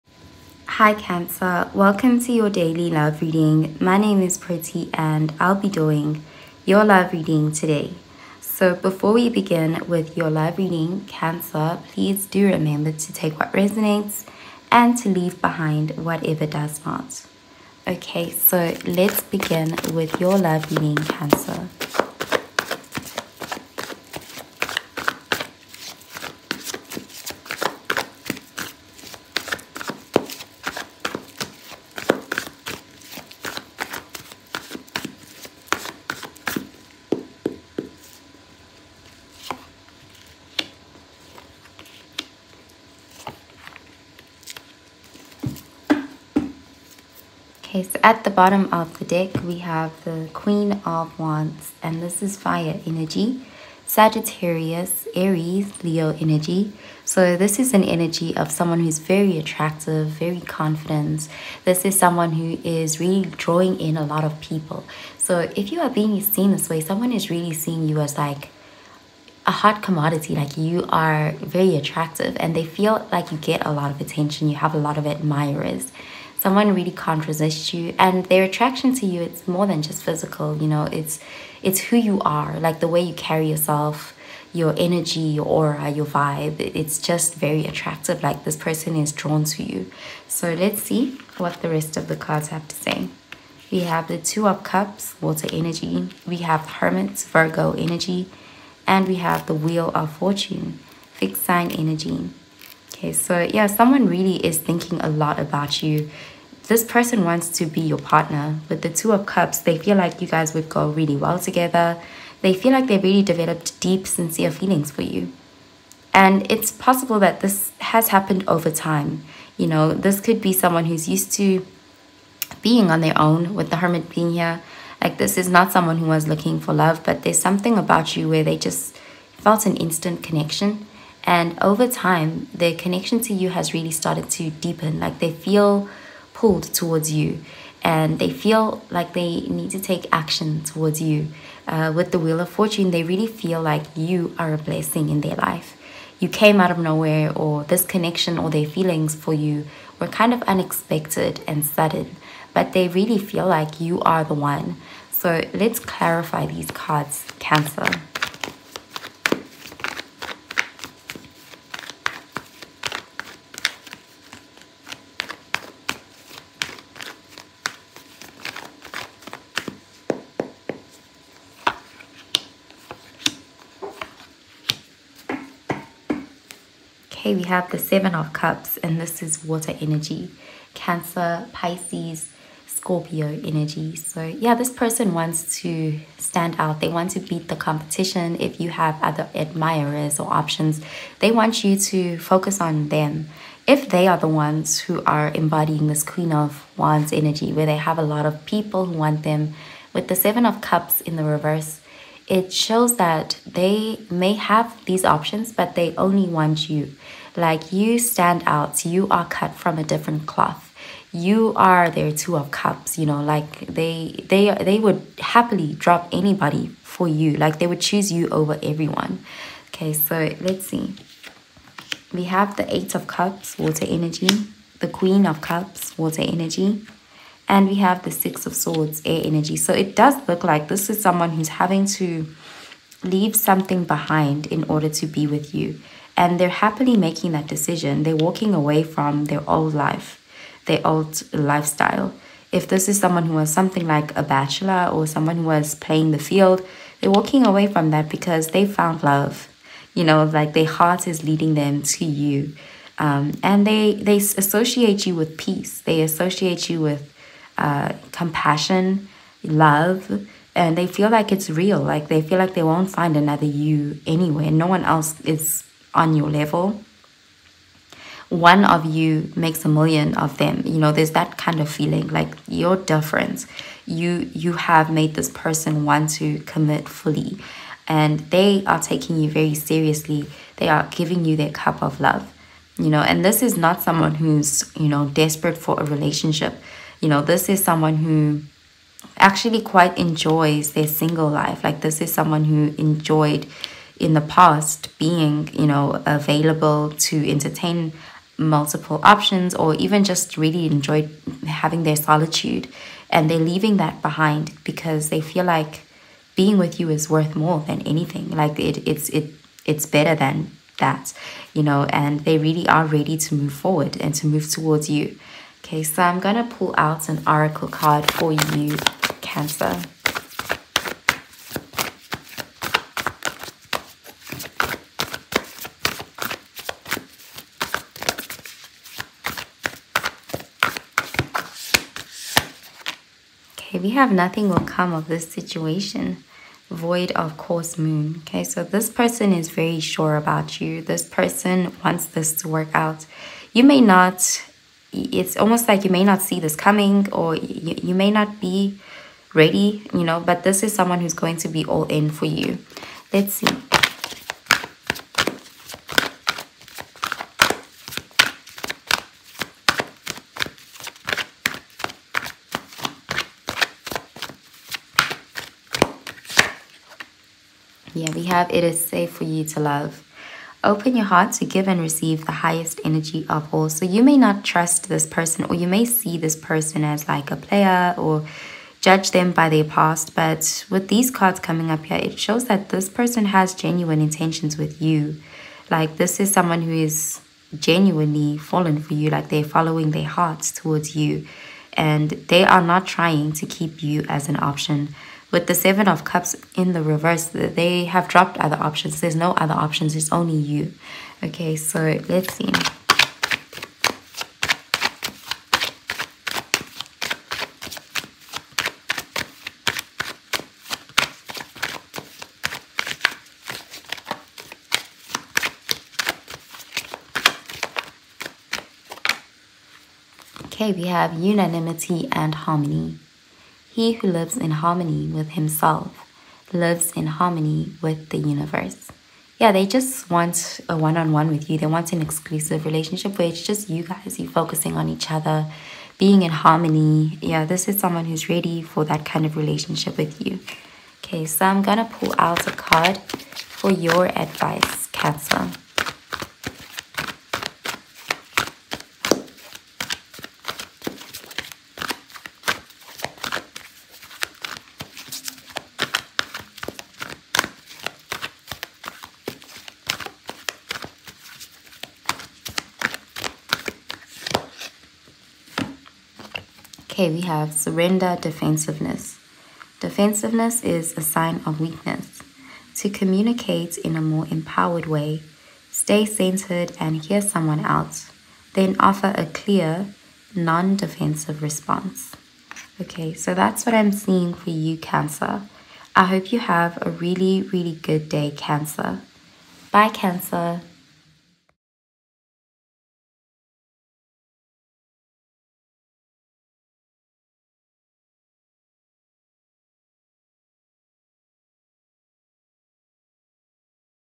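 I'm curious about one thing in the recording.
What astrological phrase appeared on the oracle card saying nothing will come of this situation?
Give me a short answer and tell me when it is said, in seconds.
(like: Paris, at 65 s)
void of course moon, at 336 s.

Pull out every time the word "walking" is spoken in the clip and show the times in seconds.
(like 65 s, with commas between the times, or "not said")
238 s, 247 s.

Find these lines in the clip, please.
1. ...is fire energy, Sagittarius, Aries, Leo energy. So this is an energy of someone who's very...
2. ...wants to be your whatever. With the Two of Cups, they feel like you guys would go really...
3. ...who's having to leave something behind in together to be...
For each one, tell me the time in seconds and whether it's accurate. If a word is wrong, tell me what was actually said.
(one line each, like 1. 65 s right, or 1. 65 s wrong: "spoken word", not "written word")
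1. 52 s right
2. 107 s wrong: "partner", not "whatever"
3. 231 s wrong: "order", not "together".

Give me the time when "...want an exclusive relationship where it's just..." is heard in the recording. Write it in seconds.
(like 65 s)
431 s.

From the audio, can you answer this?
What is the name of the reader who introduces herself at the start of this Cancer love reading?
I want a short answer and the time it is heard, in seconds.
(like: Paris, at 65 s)
Pretty, at 4 s.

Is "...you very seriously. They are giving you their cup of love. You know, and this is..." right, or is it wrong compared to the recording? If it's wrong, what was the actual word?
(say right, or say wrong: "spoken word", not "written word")
right.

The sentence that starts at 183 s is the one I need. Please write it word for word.
So, yeah, this person wants to stand out.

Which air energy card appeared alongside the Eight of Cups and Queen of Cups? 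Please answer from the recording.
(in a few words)
Six of Swords.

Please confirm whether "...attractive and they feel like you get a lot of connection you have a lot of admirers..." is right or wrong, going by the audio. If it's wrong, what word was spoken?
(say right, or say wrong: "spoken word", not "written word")
wrong: "attention", not "connection".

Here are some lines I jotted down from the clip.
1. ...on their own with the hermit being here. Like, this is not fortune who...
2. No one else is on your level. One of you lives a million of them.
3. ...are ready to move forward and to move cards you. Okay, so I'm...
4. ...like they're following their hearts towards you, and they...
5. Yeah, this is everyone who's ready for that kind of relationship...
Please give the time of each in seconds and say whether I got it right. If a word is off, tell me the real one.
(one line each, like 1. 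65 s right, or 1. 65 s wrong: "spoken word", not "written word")
1. 122 s wrong: "someone", not "fortune"
2. 264 s wrong: "makes", not "lives"
3. 312 s wrong: "towards", not "cards"
4. 389 s right
5. 437 s wrong: "someone", not "everyone".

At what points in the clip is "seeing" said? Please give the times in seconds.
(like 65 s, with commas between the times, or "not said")
67 s, 483 s.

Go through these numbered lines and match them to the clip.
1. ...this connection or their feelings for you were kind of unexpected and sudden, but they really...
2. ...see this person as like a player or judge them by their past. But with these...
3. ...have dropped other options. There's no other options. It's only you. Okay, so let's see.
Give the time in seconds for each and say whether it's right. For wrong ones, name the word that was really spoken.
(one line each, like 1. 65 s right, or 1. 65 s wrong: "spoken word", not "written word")
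1. 147 s right
2. 375 s right
3. 397 s right.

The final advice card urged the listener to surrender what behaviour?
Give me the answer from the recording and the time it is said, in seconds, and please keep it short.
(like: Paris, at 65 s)
defensiveness, at 467 s.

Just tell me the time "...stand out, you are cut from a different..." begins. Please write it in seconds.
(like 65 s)
207 s.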